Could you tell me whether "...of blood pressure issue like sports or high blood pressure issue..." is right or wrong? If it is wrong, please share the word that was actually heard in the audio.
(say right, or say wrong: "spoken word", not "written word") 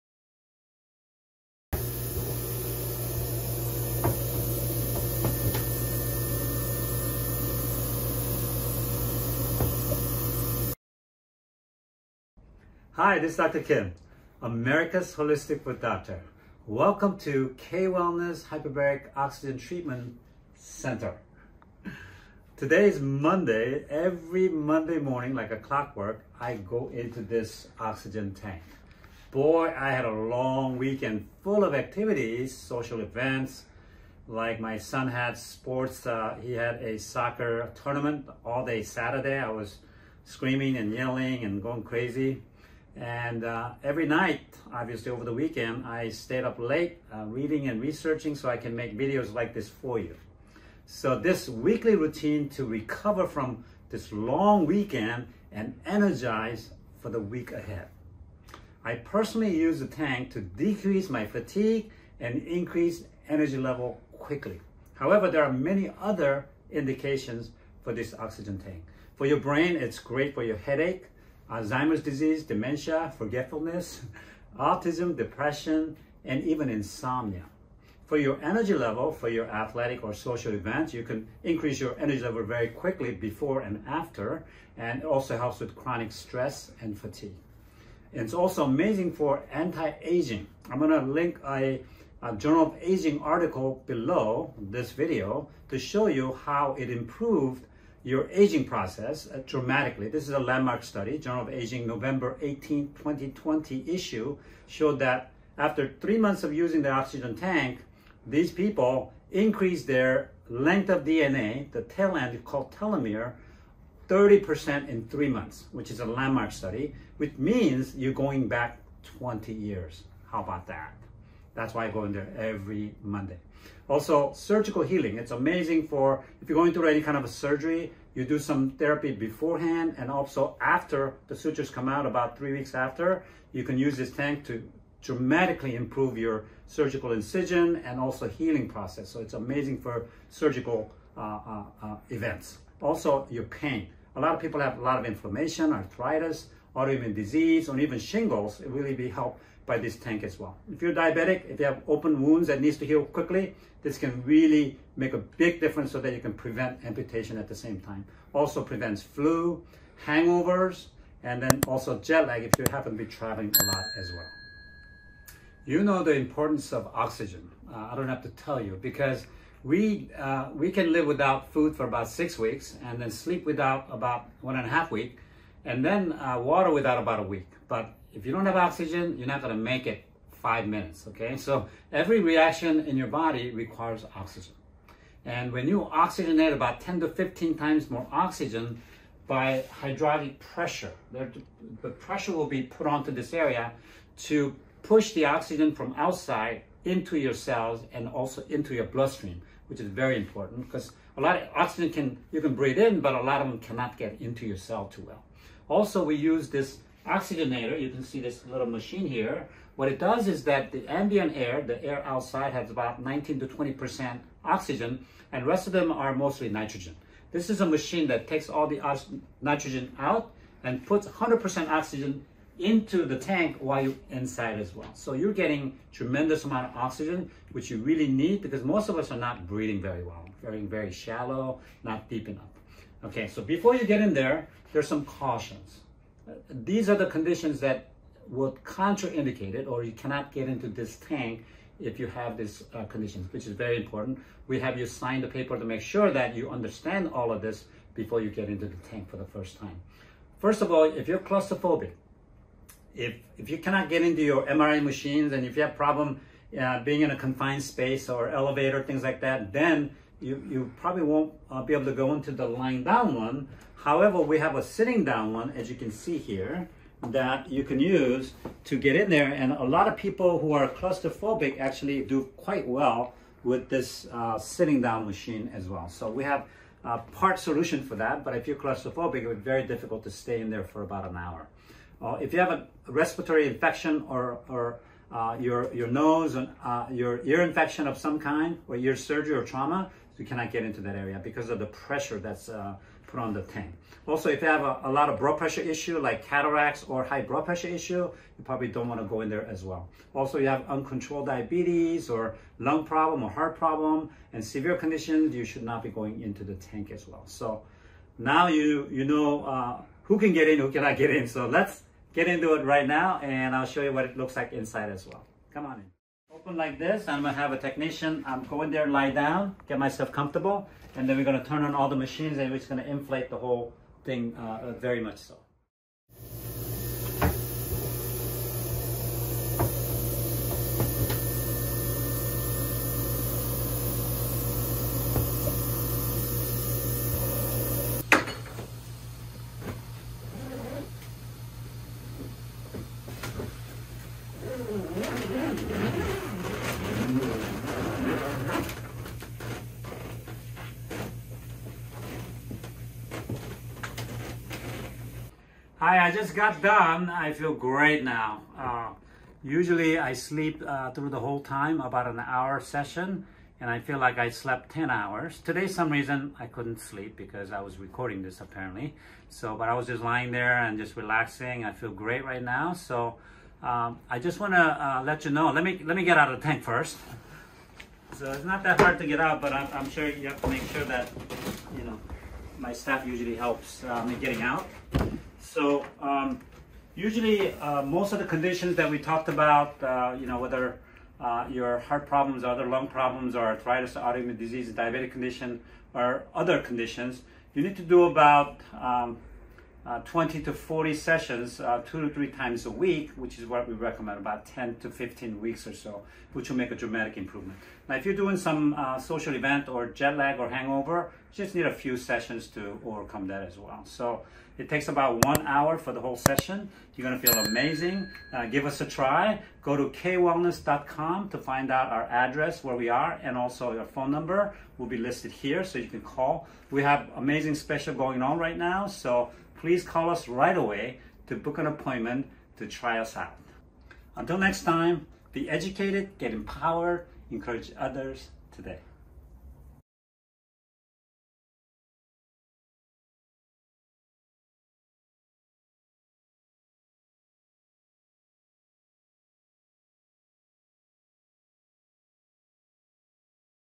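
wrong: "cataracts", not "sports".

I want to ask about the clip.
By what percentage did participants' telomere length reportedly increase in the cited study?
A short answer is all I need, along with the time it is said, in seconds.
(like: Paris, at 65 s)
30%, at 114 s.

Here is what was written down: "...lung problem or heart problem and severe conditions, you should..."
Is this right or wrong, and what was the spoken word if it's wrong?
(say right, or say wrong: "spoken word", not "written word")
right.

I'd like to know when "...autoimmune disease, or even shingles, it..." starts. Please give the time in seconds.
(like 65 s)
146 s.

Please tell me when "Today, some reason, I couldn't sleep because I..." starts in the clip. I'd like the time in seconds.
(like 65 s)
365 s.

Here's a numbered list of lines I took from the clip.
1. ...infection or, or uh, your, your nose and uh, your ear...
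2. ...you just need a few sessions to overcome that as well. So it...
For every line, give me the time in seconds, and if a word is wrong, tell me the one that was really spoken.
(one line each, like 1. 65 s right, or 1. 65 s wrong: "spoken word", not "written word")
1. 283 s right
2. 411 s right.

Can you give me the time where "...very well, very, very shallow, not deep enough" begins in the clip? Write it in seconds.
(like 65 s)
229 s.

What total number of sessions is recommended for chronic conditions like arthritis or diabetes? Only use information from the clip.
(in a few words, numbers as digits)
20 to 40.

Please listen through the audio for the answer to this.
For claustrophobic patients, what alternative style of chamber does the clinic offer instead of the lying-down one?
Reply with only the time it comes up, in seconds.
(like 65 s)
264 s.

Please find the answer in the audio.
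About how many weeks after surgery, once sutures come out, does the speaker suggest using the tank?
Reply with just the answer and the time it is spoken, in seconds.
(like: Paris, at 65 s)
3 weeks, at 132 s.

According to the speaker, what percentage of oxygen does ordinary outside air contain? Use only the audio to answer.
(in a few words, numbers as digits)
19 to 20%.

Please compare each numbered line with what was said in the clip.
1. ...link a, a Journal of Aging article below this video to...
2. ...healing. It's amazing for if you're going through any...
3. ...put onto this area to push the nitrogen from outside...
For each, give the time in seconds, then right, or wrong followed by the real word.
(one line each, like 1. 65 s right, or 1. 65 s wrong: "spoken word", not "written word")
1. 91 s right
2. 124 s right
3. 192 s wrong: "oxygen", not "nitrogen".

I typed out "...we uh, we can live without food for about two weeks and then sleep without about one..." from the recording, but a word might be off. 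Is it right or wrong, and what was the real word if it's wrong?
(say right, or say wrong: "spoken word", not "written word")
wrong: "six", not "two".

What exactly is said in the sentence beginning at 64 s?
However, there are many other indications for this oxygen tank.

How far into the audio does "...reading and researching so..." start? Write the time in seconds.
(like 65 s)
47 s.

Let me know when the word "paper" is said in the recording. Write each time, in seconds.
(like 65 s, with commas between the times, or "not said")
245 s.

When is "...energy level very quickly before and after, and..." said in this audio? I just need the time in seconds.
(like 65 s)
81 s.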